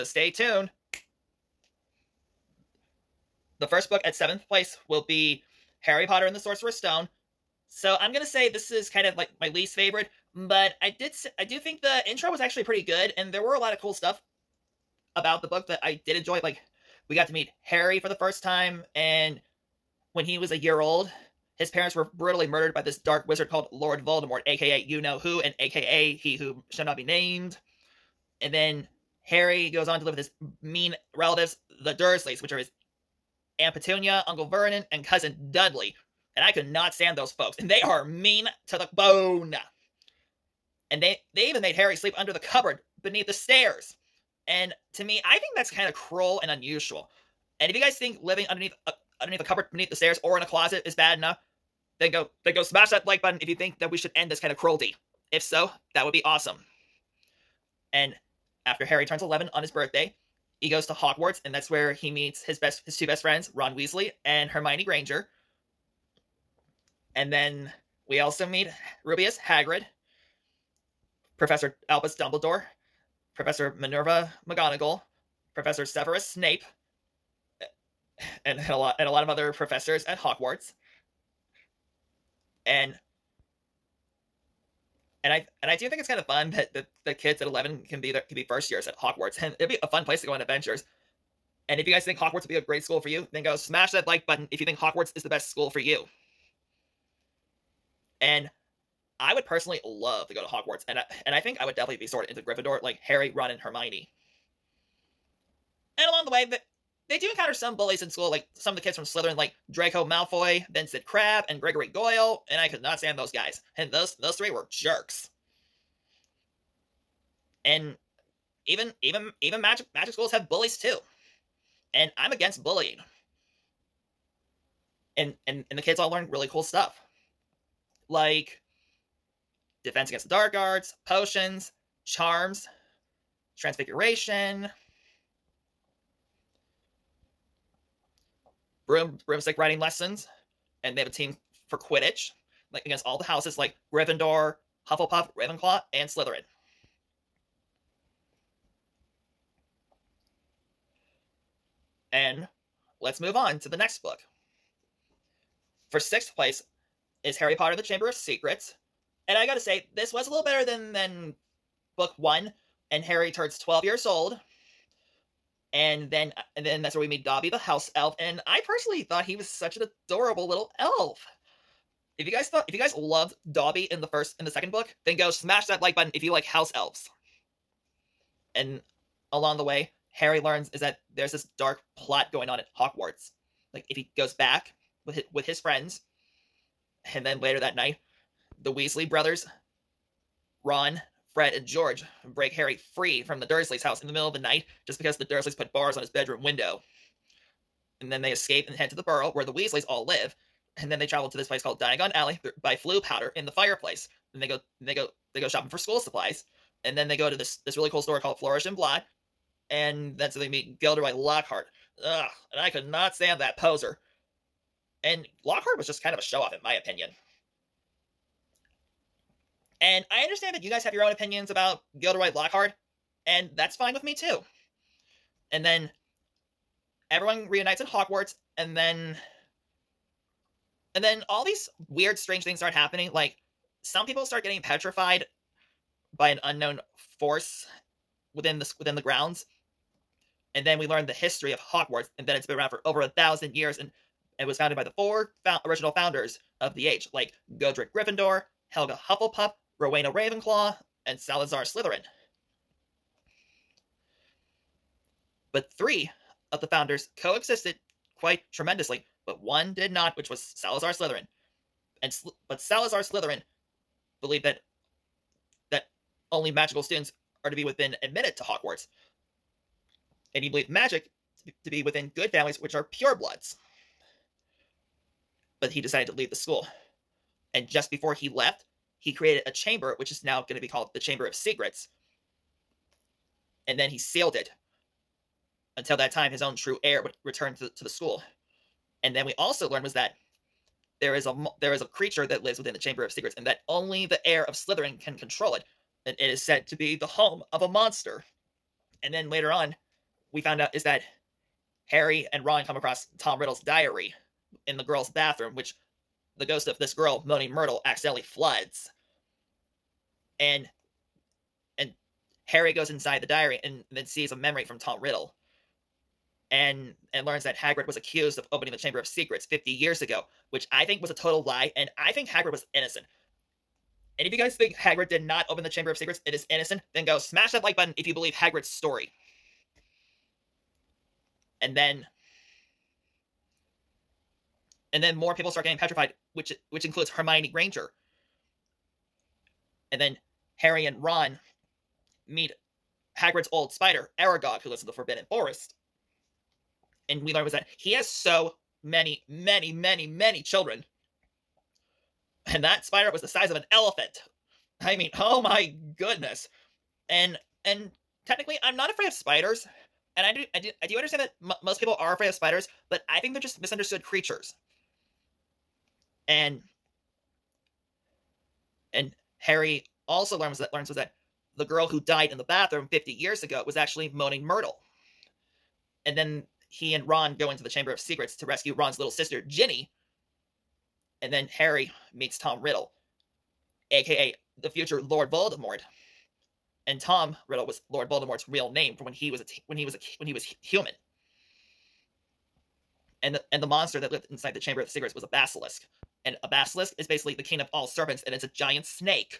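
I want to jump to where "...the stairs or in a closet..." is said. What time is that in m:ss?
0:49.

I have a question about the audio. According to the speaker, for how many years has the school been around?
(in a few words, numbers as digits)
over 1,000 years.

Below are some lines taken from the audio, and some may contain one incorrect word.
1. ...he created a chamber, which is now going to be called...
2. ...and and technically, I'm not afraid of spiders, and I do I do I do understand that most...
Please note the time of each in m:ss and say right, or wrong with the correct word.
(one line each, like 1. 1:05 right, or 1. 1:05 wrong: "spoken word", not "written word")
1. 4:39 right
2. 5:57 right.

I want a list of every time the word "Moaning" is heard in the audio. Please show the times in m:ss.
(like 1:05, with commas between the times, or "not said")
5:07, 6:14.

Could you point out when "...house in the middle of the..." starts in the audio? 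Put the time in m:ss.
3:13.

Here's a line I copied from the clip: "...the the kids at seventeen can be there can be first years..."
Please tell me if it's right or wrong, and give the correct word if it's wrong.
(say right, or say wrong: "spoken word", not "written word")
wrong: "eleven", not "seventeen".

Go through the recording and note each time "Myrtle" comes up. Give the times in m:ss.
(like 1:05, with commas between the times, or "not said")
5:07, 6:14.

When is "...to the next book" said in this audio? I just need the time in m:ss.
2:33.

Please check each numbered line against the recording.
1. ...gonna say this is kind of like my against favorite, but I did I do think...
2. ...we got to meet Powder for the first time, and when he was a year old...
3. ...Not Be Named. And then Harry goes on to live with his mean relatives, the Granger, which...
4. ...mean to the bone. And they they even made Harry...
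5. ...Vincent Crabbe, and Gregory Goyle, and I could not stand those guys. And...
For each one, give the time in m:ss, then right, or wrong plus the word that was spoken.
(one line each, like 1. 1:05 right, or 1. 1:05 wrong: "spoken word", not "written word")
1. 0:08 wrong: "least", not "against"
2. 0:17 wrong: "Harry", not "Powder"
3. 0:26 wrong: "Dursleys", not "Granger"
4. 0:38 right
5. 1:50 right.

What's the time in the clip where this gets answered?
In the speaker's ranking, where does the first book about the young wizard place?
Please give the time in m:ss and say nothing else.
0:04.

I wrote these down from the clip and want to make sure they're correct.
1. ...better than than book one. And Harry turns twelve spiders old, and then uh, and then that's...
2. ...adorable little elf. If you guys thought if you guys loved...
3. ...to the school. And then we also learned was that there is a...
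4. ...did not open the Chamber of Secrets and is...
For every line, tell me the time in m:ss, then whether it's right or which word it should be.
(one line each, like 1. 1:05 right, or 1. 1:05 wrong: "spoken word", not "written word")
1. 2:40 wrong: "years", not "spiders"
2. 2:50 right
3. 4:47 right
4. 5:25 right.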